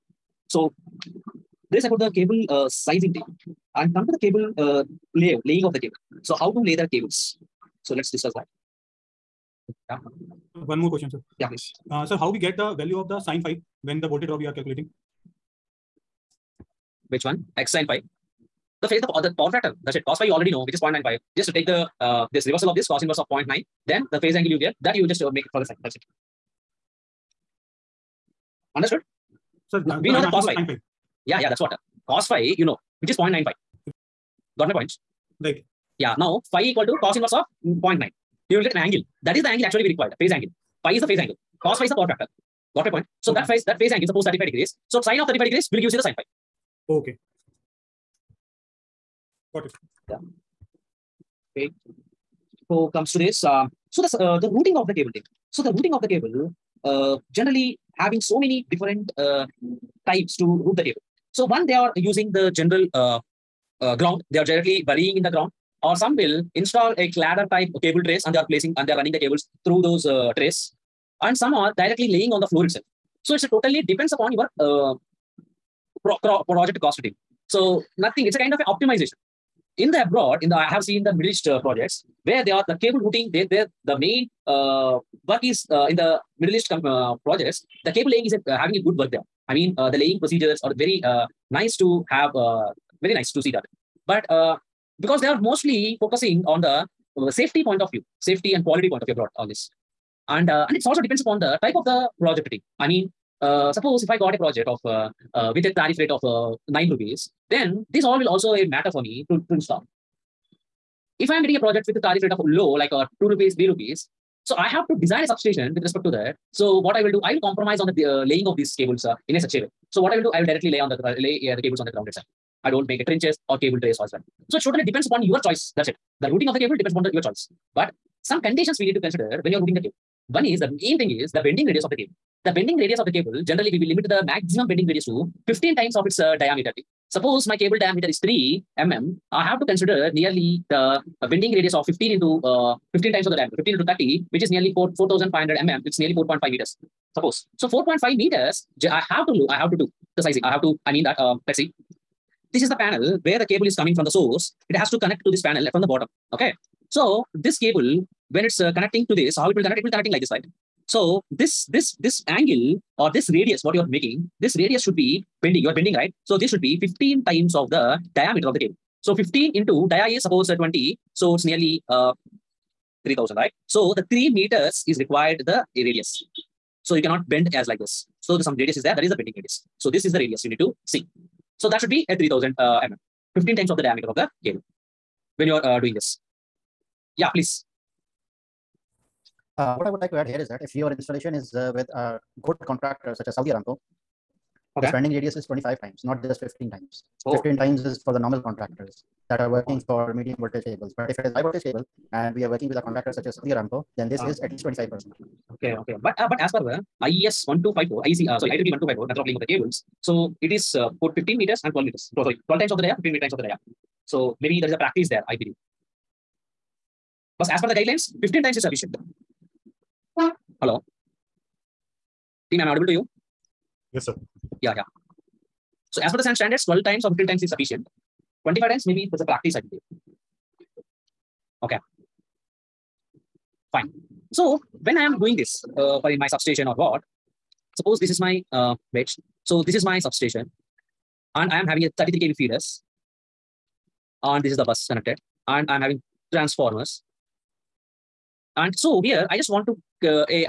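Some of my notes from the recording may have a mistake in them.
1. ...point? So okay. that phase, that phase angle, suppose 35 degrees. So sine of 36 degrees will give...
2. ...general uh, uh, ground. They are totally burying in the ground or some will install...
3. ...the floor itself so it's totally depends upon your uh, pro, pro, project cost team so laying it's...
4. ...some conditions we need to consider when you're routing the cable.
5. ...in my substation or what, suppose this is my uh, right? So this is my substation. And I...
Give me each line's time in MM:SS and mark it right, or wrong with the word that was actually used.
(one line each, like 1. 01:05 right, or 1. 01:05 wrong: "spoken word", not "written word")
1. 00:42 wrong: "35", not "36"
2. 01:02 wrong: "directly", not "totally"
3. 01:12 wrong: "nothing", not "laying"
4. 02:08 right
5. 03:56 right.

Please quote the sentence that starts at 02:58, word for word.
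So the some radius is there.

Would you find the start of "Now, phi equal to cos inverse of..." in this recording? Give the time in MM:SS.
00:36.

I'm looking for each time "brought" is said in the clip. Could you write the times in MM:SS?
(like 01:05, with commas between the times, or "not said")
01:39.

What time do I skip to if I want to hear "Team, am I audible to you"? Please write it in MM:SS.
03:42.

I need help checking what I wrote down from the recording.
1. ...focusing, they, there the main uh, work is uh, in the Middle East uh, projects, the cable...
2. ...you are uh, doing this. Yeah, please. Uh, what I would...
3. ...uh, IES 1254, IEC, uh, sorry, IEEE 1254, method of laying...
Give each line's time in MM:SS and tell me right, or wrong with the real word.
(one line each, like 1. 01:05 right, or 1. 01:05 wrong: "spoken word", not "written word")
1. 01:23 wrong: "routing", not "focusing"
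2. 03:05 right
3. 03:26 right.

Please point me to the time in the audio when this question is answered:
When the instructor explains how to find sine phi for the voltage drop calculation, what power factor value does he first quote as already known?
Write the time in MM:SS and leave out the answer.
00:20.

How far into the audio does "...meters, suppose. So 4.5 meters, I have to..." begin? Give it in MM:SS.
02:26.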